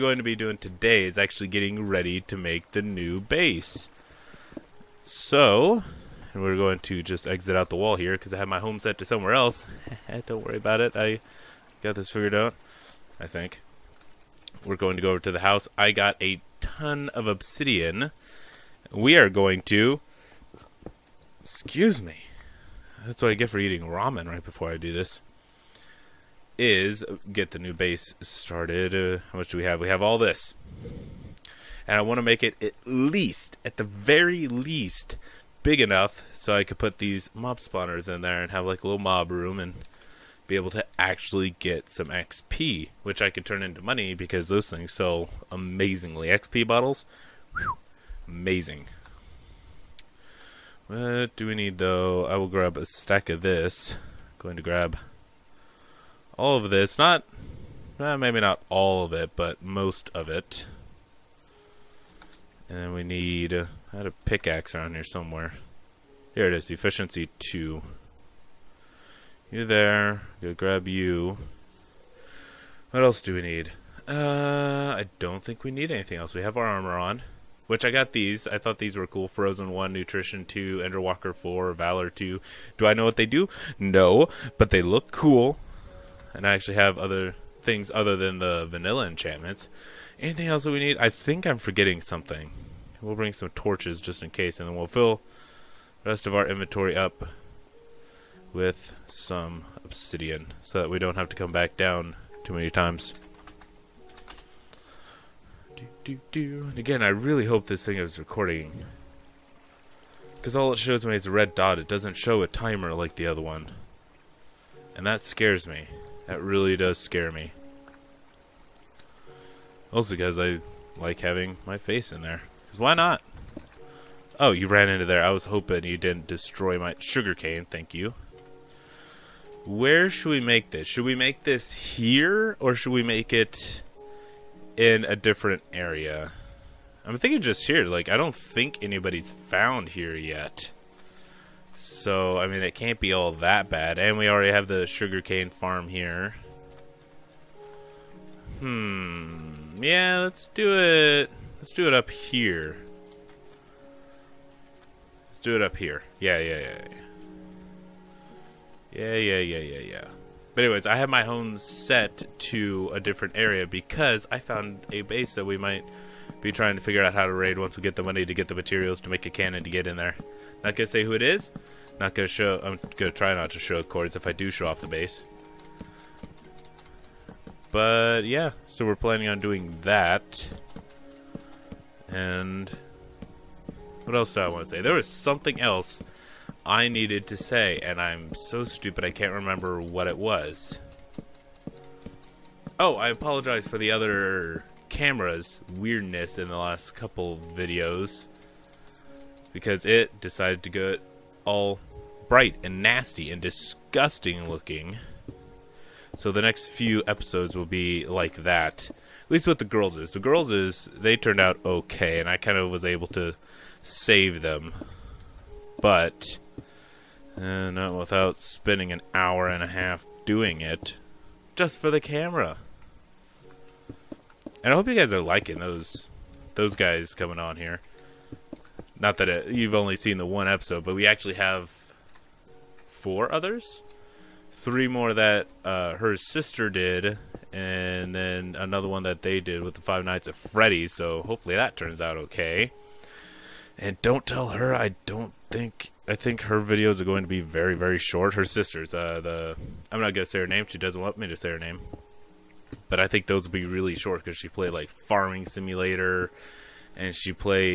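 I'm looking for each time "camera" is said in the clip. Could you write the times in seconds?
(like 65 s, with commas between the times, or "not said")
194 s, 221 s.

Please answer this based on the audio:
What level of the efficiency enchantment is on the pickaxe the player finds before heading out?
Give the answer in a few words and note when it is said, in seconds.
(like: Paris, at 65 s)
2, at 66 s.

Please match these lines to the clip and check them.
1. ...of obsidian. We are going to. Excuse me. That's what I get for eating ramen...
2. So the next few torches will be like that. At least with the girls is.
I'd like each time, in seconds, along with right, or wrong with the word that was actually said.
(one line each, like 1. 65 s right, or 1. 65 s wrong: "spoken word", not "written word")
1. 17 s right
2. 206 s wrong: "episodes", not "torches".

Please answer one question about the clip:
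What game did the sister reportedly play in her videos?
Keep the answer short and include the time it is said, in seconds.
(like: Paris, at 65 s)
Farming Simulator, at 254 s.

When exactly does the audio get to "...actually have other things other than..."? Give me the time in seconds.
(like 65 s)
86 s.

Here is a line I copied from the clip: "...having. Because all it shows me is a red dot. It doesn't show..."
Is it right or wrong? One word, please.
wrong.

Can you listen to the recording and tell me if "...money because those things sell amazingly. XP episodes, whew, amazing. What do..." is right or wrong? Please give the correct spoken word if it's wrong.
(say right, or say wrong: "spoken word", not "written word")
wrong: "bottles", not "episodes".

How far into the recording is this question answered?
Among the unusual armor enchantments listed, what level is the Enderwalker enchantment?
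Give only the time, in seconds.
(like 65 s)
80 s.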